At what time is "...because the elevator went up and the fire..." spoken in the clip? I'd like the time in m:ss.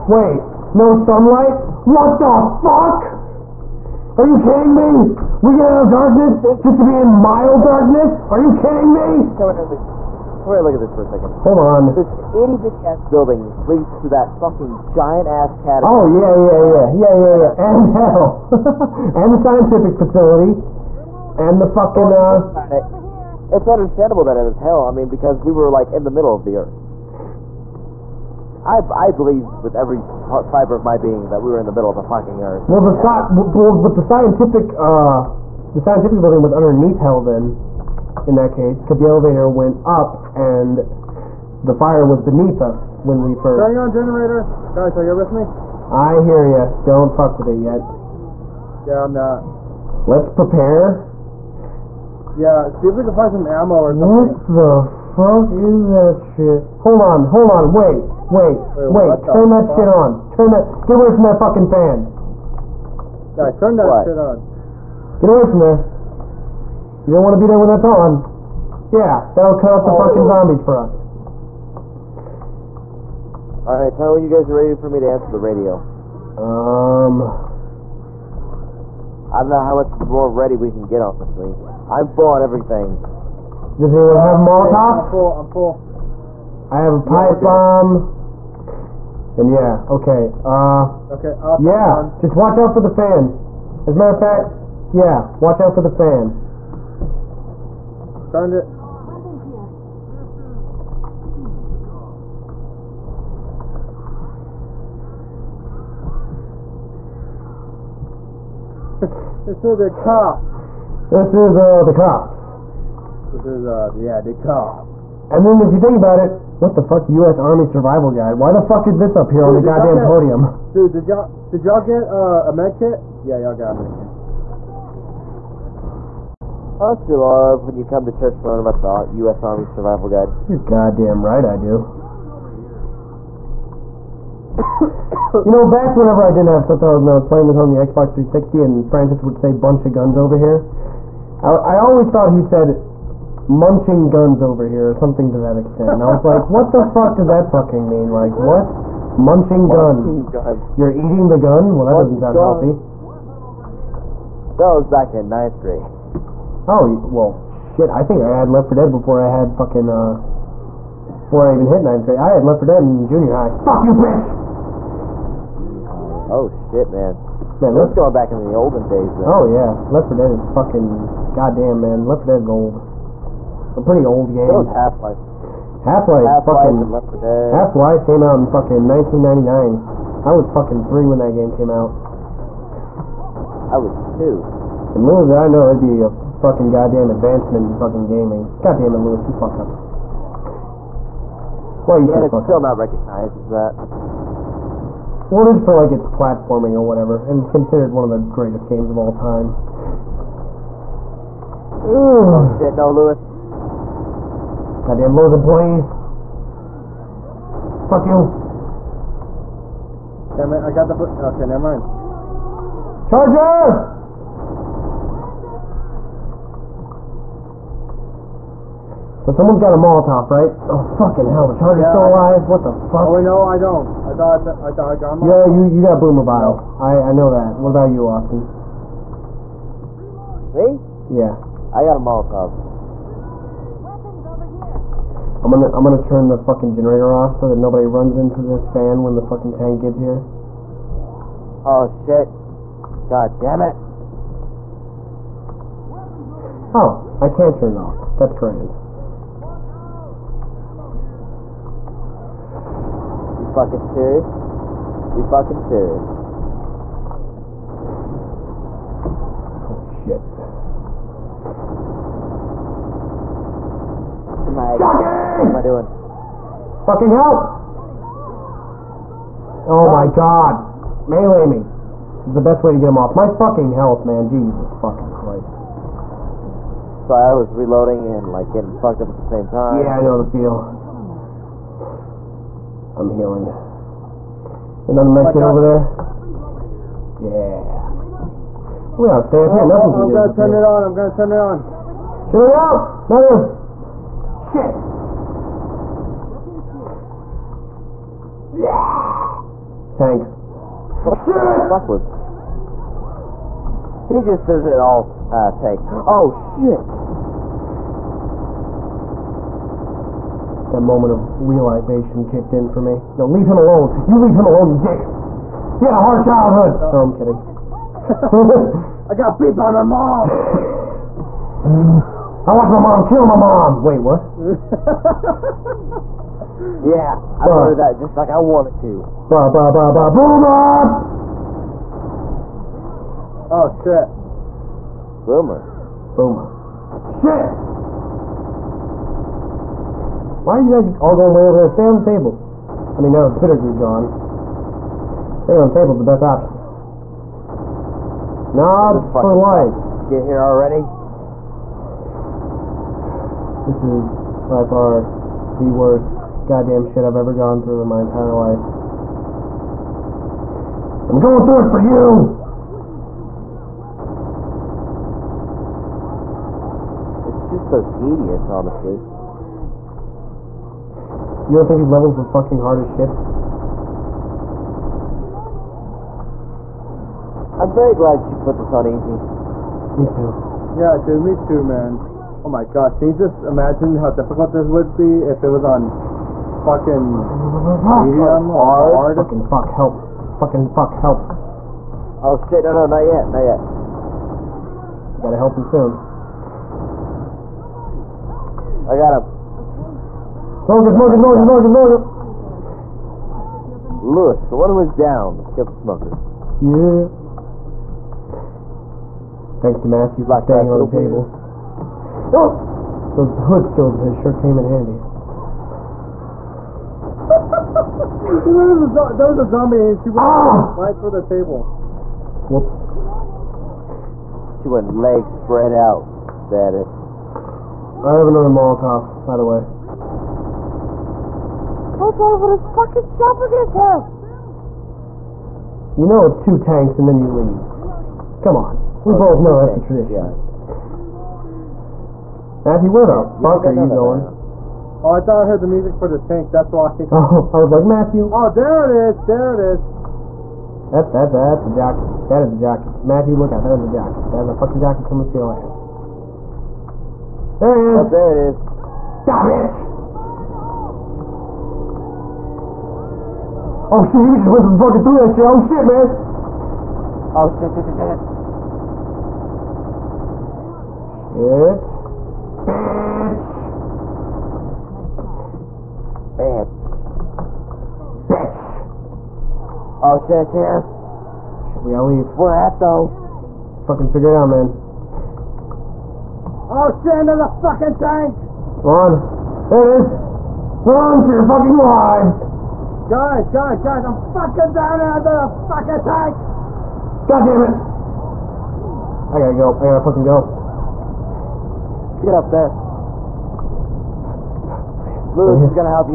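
0:38.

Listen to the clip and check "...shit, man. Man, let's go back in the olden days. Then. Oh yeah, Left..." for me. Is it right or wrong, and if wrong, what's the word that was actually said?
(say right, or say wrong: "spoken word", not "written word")
right.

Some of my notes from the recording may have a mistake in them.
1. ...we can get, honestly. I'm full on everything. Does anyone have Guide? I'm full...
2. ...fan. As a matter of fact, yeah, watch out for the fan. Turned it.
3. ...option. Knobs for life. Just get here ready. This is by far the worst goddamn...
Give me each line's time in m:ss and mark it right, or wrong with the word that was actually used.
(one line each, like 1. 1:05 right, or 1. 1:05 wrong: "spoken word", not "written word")
1. 1:20 wrong: "Molotov", not "Guide"
2. 1:32 right
3. 5:46 wrong: "already", not "ready".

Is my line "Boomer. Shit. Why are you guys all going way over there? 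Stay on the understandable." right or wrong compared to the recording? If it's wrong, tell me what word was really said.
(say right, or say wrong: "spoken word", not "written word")
wrong: "table", not "understandable".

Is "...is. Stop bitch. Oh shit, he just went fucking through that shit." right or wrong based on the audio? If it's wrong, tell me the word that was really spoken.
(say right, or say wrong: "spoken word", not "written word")
right.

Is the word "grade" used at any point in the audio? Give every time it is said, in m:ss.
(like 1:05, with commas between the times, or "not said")
2:35, 2:42.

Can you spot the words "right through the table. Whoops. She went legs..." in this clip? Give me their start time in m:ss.
7:00.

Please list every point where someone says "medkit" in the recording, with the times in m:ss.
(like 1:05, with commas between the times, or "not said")
4:45.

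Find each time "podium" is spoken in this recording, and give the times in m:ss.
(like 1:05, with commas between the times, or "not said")
2:00.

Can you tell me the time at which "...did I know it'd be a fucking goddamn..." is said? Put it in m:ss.
3:05.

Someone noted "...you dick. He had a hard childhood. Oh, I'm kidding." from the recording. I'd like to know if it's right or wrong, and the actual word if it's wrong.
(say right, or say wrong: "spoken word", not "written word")
right.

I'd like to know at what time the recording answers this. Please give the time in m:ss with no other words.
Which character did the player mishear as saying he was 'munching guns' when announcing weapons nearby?
2:18.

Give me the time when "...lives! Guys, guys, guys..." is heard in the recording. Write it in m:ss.
8:11.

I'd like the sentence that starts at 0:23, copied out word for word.
It's understandable that it is hell.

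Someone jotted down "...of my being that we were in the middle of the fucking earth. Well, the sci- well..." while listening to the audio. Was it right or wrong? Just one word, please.
right.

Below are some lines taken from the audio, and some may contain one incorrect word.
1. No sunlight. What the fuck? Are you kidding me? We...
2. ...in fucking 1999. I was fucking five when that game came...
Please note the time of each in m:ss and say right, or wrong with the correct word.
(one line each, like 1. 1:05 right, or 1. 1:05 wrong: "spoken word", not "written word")
1. 0:00 right
2. 2:58 wrong: "three", not "five".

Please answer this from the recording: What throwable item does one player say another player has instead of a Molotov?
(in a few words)
Boomer Bile.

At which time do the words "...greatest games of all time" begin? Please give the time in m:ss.
3:18.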